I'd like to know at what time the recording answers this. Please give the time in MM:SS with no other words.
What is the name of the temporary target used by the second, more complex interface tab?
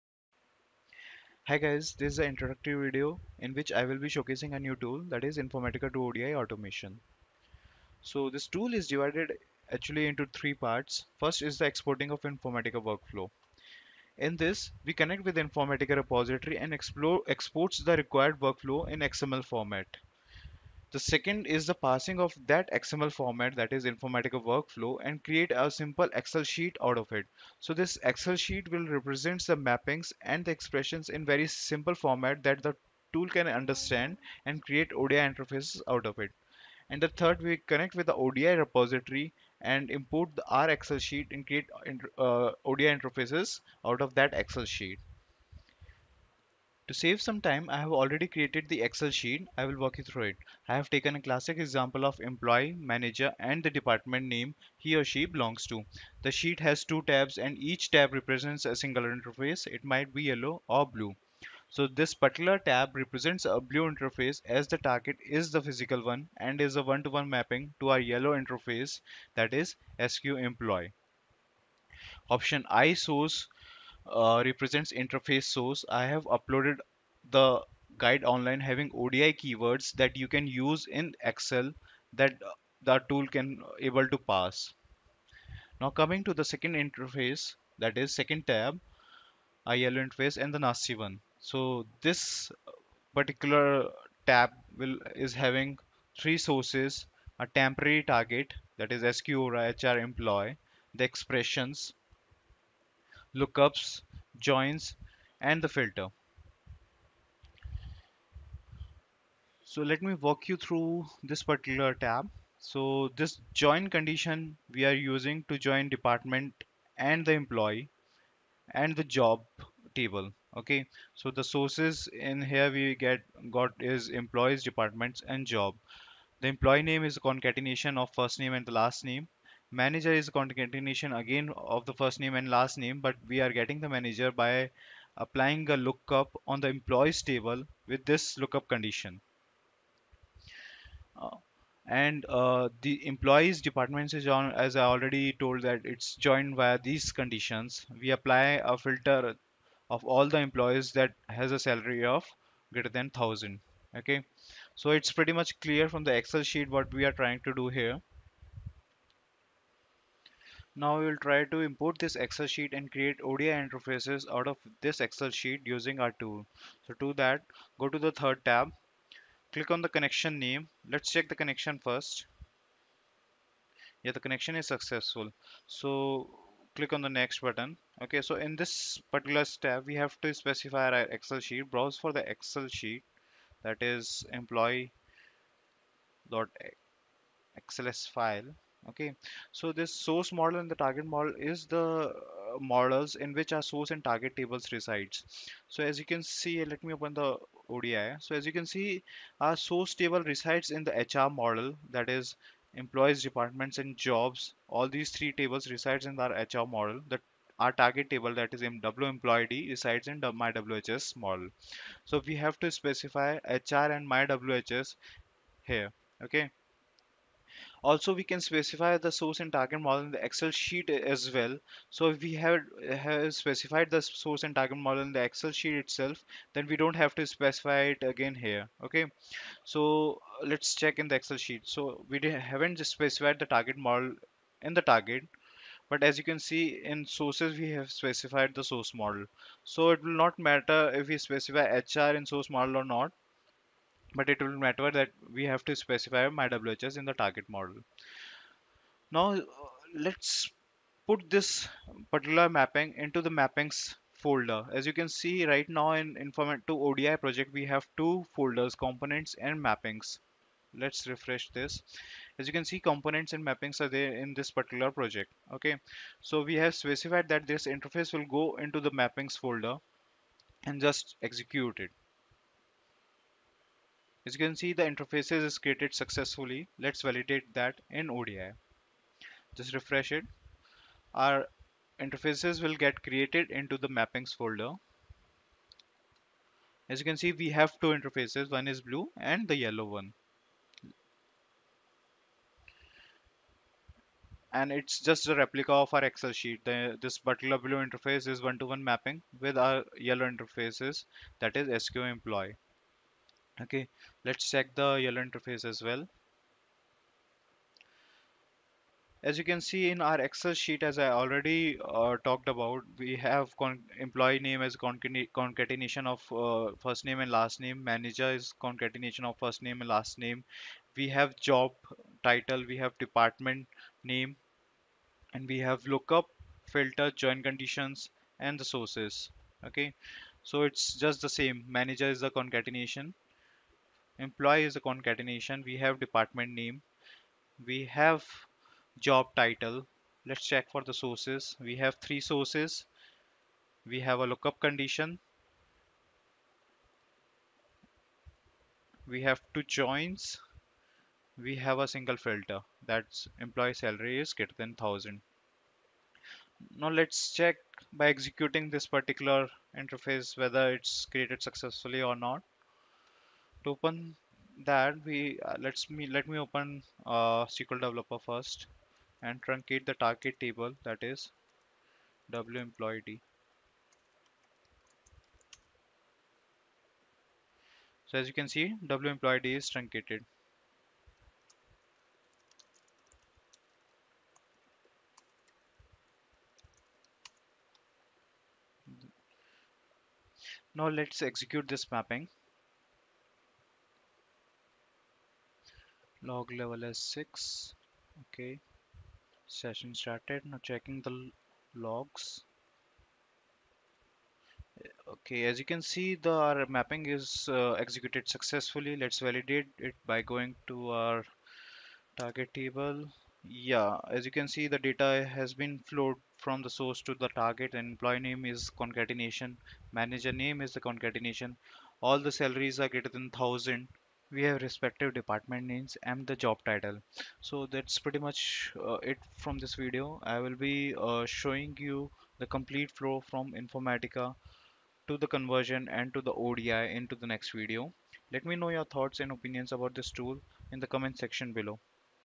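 01:39.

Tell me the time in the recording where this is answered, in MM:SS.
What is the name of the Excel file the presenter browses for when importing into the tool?
03:04.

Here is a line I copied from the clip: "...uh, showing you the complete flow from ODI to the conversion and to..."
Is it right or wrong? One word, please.
wrong.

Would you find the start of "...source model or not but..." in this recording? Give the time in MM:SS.
04:02.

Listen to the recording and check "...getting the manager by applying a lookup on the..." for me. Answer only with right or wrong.
right.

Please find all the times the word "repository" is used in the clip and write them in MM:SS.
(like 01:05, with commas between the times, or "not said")
00:15, 00:38.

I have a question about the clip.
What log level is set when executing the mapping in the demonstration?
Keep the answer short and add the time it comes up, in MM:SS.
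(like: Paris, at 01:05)
6, at 06:37.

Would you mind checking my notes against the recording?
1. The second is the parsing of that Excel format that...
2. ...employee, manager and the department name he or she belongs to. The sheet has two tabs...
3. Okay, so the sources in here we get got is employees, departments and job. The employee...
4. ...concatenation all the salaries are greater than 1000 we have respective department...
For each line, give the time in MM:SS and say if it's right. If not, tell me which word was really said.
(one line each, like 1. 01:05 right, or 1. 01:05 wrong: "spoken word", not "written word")
1. 00:20 wrong: "XML", not "Excel"
2. 00:52 right
3. 02:00 right
4. 07:00 right.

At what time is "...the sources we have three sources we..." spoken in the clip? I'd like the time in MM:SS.
05:40.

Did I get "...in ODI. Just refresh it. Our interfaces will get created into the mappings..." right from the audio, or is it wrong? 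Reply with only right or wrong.
right.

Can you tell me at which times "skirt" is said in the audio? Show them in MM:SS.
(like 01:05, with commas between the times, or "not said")
not said.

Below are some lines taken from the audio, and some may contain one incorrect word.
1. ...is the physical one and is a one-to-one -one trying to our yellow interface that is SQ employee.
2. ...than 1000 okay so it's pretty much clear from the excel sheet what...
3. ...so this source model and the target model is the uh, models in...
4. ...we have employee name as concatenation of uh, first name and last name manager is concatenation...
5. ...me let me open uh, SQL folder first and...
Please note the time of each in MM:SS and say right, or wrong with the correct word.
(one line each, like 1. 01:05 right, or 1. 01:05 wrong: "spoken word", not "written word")
1. 01:05 wrong: "mapping", not "trying"
2. 02:32 right
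3. 03:09 right
4. 05:12 right
5. 06:05 wrong: "developer", not "folder".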